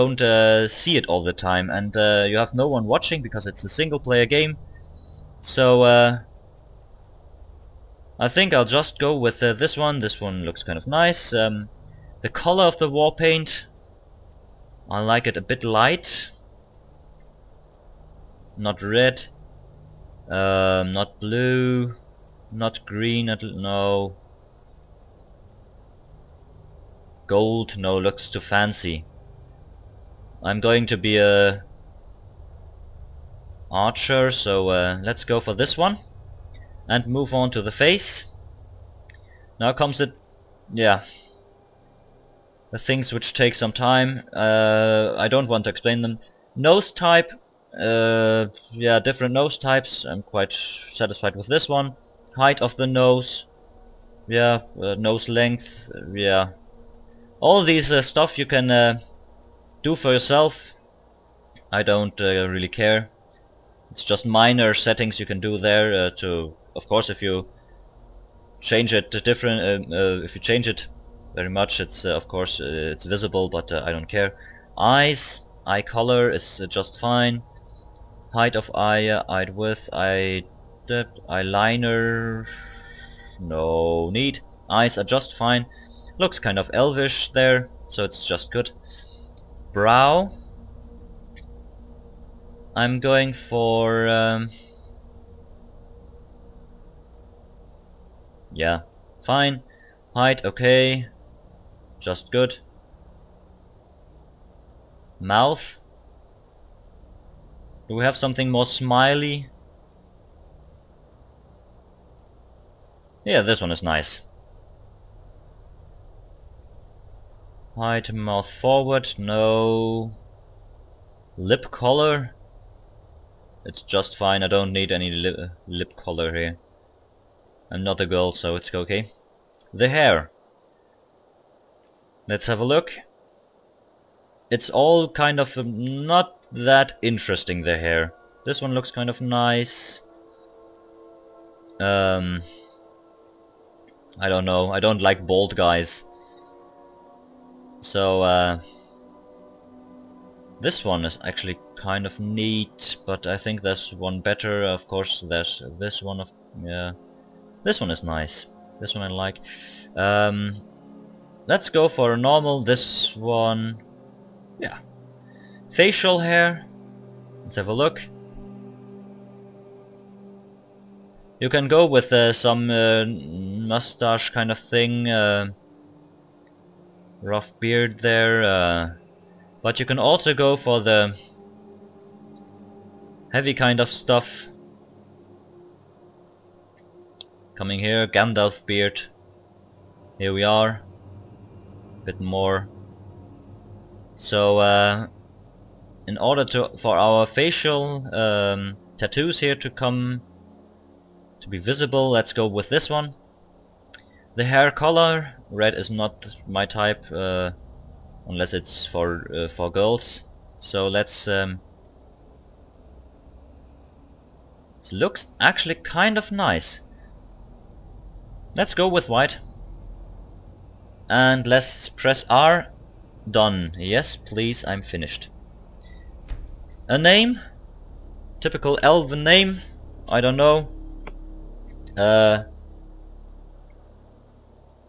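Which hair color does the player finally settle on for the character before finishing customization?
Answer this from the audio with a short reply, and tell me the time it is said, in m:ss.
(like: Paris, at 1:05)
White, at 3:39.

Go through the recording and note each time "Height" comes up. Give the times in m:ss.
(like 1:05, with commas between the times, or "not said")
0:52, 1:18, 1:40, 1:57.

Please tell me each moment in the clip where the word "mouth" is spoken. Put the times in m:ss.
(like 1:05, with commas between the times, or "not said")
1:45, 1:58.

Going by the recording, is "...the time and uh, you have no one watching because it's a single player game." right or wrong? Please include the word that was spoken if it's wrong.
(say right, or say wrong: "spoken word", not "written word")
right.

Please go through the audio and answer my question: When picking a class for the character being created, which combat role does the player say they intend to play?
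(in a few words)
Archer.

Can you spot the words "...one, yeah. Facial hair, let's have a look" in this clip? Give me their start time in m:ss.
2:43.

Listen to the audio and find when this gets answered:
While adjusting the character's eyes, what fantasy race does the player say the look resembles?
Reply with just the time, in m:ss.
1:26.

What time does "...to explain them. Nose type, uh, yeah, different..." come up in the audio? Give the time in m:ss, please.
0:45.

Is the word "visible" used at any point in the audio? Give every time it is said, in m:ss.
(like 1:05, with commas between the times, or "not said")
1:13, 3:21.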